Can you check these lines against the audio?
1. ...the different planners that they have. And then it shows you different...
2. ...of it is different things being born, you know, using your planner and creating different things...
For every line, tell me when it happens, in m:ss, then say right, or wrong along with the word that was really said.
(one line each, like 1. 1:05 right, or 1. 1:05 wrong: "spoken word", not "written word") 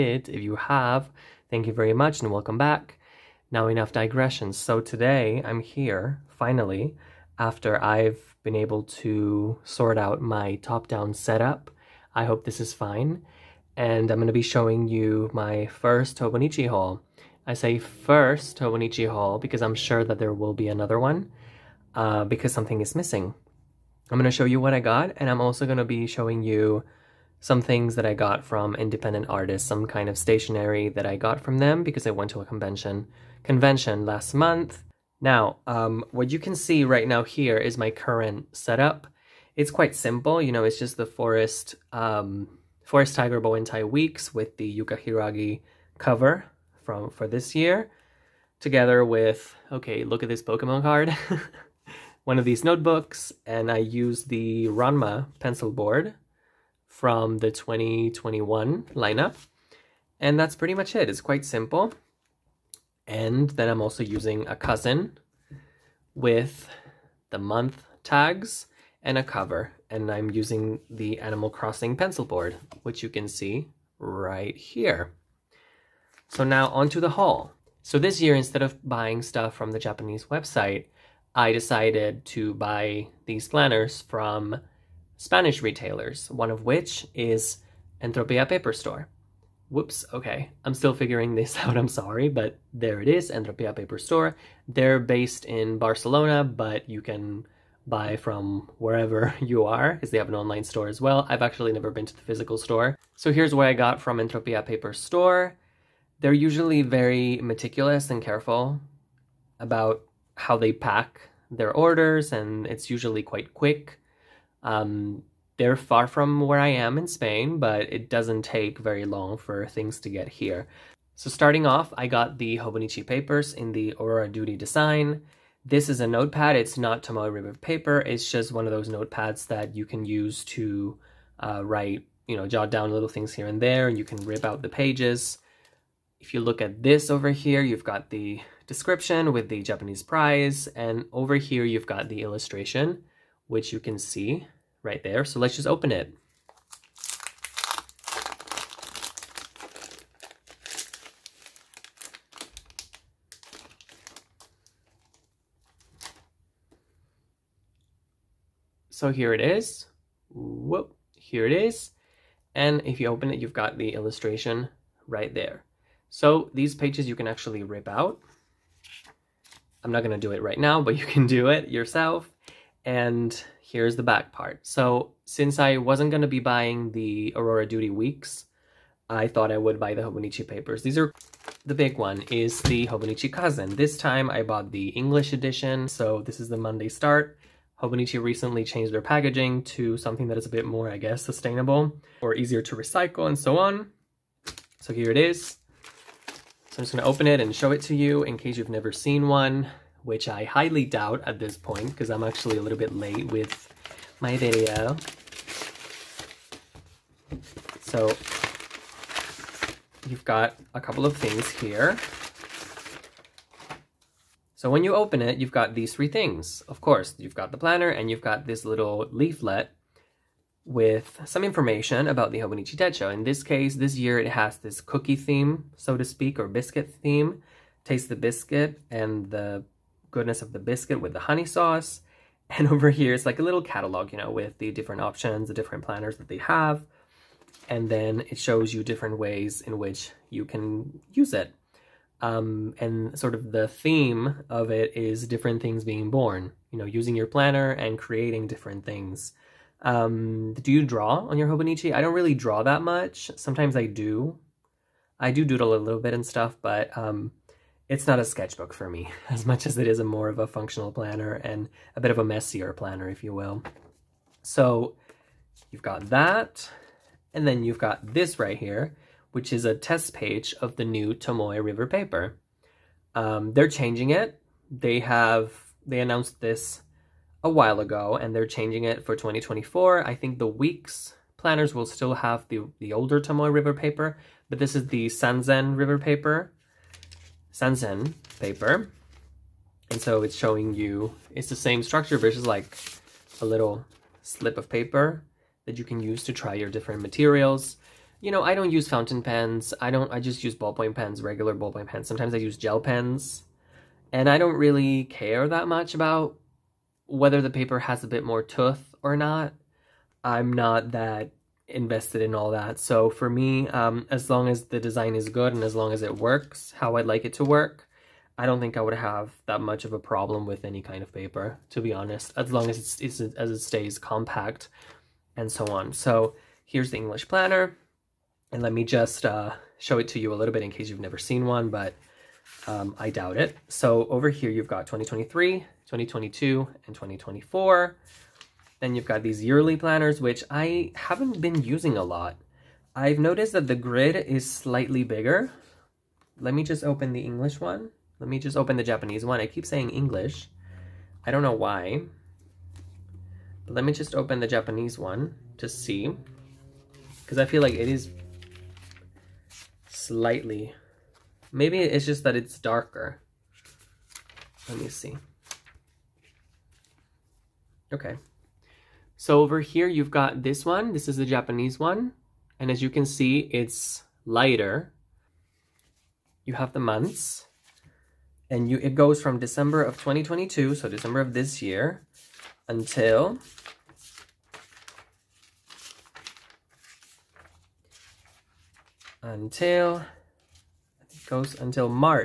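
1. 3:55 right
2. 4:04 right.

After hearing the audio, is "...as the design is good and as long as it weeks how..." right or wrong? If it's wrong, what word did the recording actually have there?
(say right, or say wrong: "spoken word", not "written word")
wrong: "works", not "weeks".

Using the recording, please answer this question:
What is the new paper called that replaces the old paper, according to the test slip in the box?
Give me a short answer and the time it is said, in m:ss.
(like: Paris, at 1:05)
Sanzen paper, at 4:47.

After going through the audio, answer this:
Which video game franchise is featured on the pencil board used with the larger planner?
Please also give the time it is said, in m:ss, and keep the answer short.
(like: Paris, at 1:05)
Animal Crossing, at 1:11.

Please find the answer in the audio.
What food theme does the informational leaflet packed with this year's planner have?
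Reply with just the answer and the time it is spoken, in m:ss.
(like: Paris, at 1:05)
Cookie, at 3:44.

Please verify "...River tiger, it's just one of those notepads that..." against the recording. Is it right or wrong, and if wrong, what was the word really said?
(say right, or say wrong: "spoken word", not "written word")
wrong: "paper", not "tiger".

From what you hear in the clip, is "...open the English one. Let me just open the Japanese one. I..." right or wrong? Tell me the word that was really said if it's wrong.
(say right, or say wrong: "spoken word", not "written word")
right.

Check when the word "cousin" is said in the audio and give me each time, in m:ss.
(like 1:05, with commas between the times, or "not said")
1:04, 3:03.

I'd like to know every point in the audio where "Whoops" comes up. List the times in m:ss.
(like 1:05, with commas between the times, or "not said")
1:29, 2:40.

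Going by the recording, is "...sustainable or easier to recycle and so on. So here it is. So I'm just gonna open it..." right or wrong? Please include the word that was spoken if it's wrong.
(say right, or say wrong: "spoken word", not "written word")
right.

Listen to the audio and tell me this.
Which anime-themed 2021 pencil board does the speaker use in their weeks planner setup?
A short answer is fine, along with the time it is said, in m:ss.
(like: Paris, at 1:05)
Ranma, at 0:54.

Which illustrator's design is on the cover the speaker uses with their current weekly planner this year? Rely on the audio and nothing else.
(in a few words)
Yuka Hiiragi.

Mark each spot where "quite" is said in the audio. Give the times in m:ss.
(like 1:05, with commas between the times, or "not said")
0:39, 1:01, 1:53.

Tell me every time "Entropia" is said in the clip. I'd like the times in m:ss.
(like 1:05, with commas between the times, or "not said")
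1:28, 1:33, 1:44.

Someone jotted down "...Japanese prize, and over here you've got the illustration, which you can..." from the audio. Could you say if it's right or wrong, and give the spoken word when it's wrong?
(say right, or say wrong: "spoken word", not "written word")
right.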